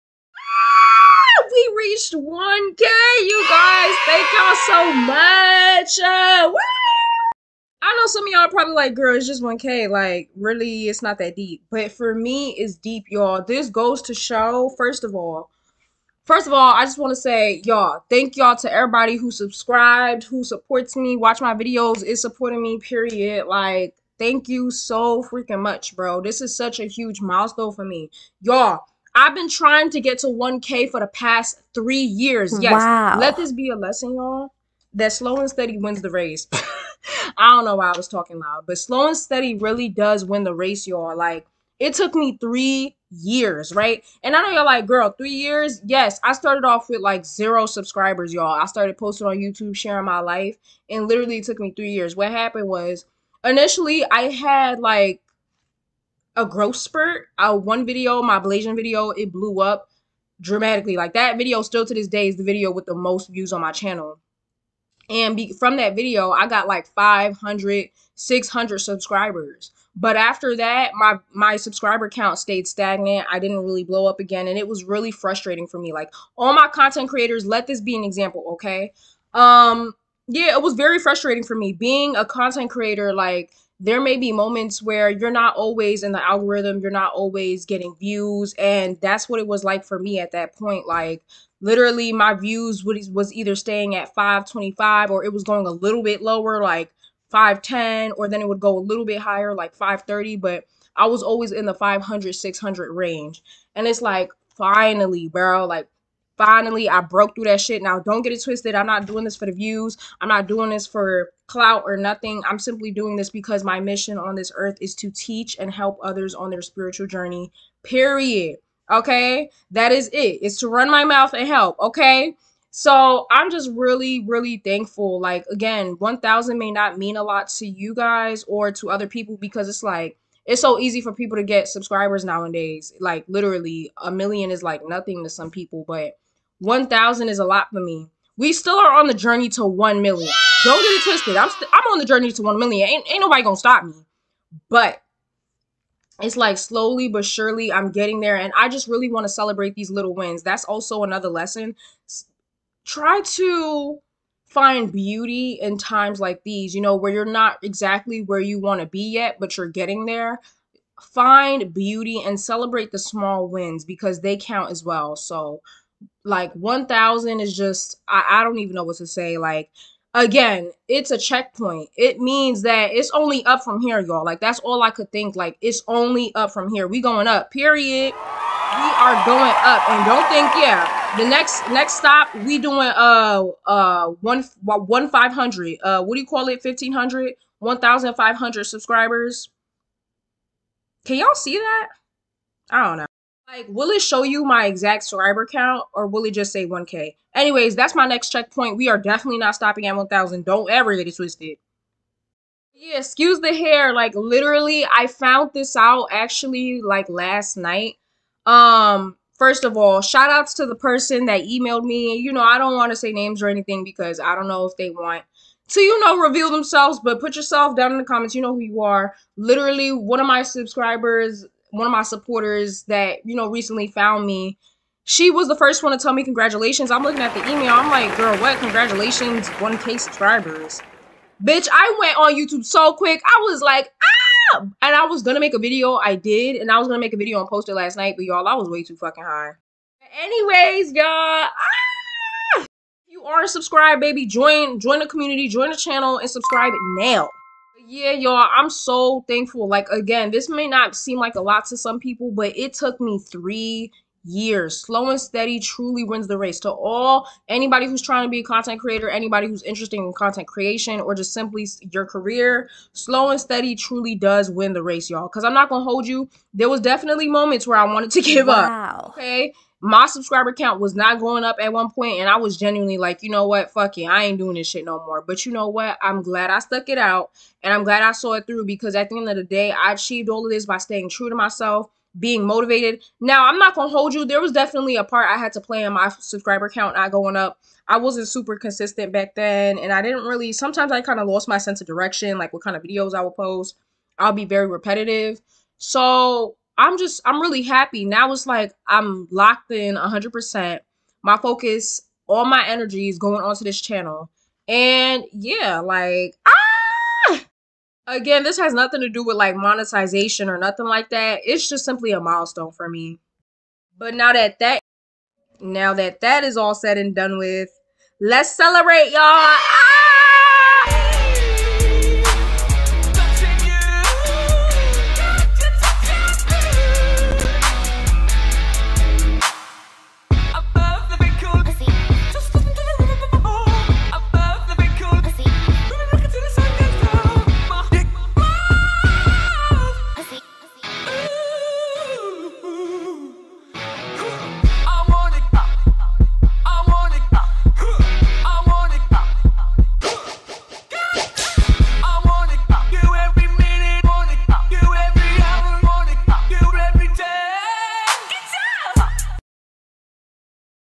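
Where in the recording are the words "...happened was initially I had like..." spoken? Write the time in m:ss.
0:52.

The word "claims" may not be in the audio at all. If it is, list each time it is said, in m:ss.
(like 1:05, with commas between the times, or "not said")
not said.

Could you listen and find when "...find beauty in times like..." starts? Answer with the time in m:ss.
2:34.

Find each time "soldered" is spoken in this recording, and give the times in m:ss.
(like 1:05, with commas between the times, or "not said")
not said.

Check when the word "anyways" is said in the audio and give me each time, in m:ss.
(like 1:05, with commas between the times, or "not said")
3:17, 4:00.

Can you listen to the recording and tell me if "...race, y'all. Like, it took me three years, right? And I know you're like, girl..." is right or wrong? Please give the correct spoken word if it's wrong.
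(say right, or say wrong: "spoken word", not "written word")
right.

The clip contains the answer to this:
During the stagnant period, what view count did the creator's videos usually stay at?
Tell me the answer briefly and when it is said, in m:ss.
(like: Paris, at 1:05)
525, at 1:34.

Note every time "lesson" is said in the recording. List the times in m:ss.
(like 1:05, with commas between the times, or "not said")
0:33, 2:31.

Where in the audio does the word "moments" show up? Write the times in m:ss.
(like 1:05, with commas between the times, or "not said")
1:24, 4:27.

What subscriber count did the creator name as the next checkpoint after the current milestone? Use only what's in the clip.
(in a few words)
1500.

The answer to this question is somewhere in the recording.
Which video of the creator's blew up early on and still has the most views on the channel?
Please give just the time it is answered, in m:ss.
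0:58.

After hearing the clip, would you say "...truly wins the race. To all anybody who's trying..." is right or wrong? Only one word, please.
right.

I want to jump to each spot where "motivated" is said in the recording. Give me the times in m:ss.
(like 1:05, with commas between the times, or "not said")
4:42.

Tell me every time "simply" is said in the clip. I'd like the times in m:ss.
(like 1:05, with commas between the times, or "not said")
1:52, 4:21, 5:11.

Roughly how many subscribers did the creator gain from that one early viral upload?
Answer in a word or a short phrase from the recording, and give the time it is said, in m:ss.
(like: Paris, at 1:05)
500, 600, at 1:06.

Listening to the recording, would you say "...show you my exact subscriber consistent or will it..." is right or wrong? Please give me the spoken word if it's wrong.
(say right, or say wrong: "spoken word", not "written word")
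wrong: "count", not "consistent".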